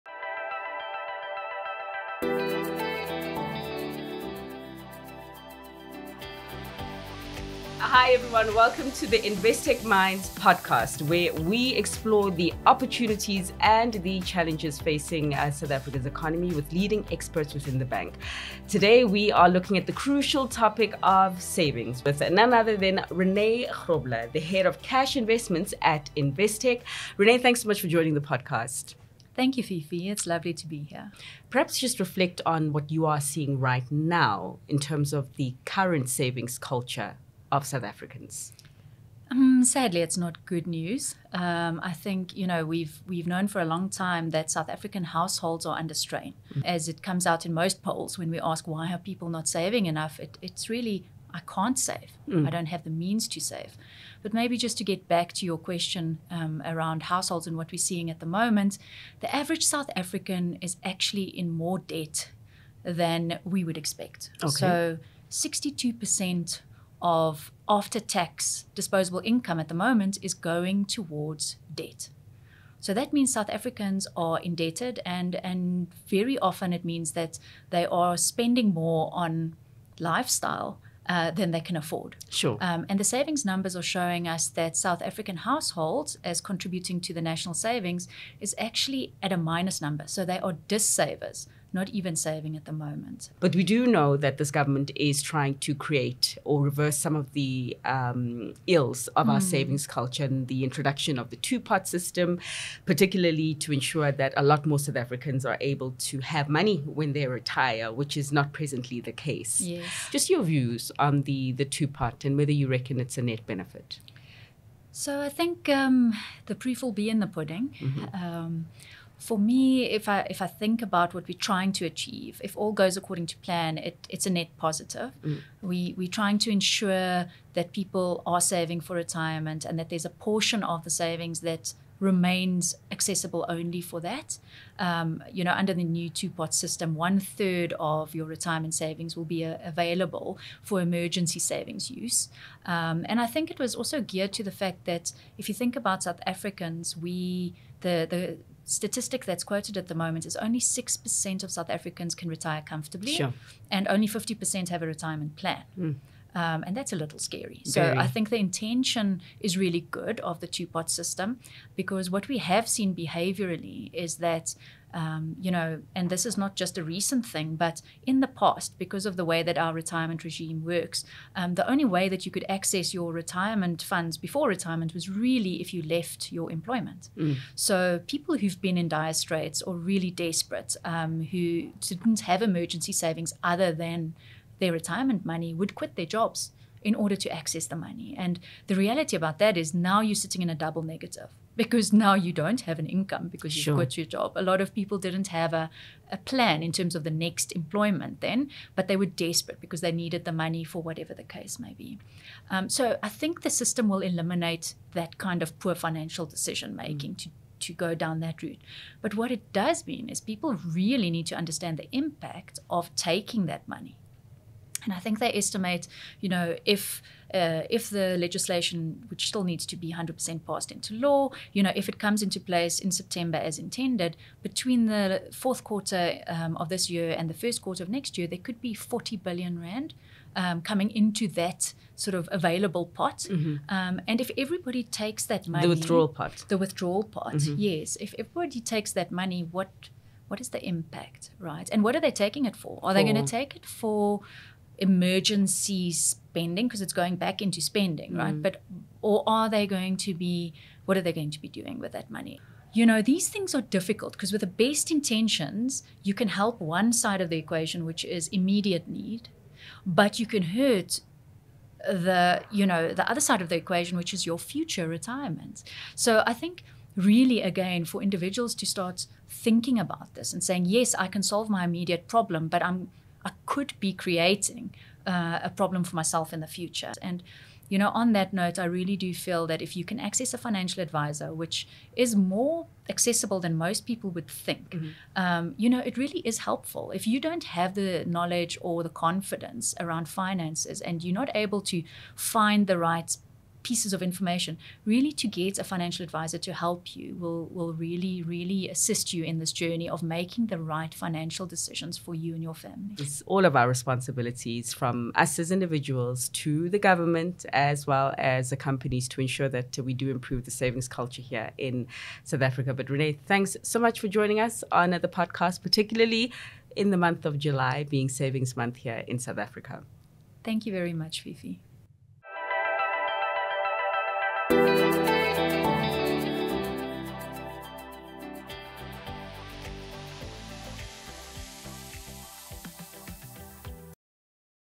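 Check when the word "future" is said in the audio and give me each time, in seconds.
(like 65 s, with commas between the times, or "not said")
264 s, 276 s.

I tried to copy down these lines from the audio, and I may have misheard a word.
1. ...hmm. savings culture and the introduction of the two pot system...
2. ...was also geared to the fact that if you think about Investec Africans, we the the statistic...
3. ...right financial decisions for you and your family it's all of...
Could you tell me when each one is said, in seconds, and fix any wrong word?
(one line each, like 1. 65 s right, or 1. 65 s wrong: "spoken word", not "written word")
1. 99 s right
2. 143 s wrong: "South", not "Investec"
3. 300 s right.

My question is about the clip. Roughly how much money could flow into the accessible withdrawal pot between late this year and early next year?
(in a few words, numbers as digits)
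40 billion rand.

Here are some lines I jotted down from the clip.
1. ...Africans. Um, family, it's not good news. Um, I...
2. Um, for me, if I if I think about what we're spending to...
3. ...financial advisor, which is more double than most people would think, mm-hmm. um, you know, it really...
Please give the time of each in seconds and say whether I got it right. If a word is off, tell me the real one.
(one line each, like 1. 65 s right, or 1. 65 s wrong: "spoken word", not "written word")
1. 37 s wrong: "sadly", not "family"
2. 118 s wrong: "trying", not "spending"
3. 280 s wrong: "accessible", not "double".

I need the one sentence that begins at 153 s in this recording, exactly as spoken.
and only 50% have a retirement plan.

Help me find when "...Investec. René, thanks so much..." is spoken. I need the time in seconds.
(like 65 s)
26 s.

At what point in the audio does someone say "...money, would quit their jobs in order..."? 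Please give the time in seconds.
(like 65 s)
185 s.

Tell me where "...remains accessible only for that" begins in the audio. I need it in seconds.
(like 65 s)
131 s.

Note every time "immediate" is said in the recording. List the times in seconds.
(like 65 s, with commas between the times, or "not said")
258 s, 271 s.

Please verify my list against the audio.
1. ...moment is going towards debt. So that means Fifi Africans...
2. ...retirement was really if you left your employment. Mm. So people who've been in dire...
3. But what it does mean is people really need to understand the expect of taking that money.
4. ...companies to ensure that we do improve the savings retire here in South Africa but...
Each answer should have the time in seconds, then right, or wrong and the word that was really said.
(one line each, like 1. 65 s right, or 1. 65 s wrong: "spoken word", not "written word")
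1. 69 s wrong: "South", not "Fifi"
2. 174 s right
3. 209 s wrong: "impact", not "expect"
4. 308 s wrong: "culture", not "retire".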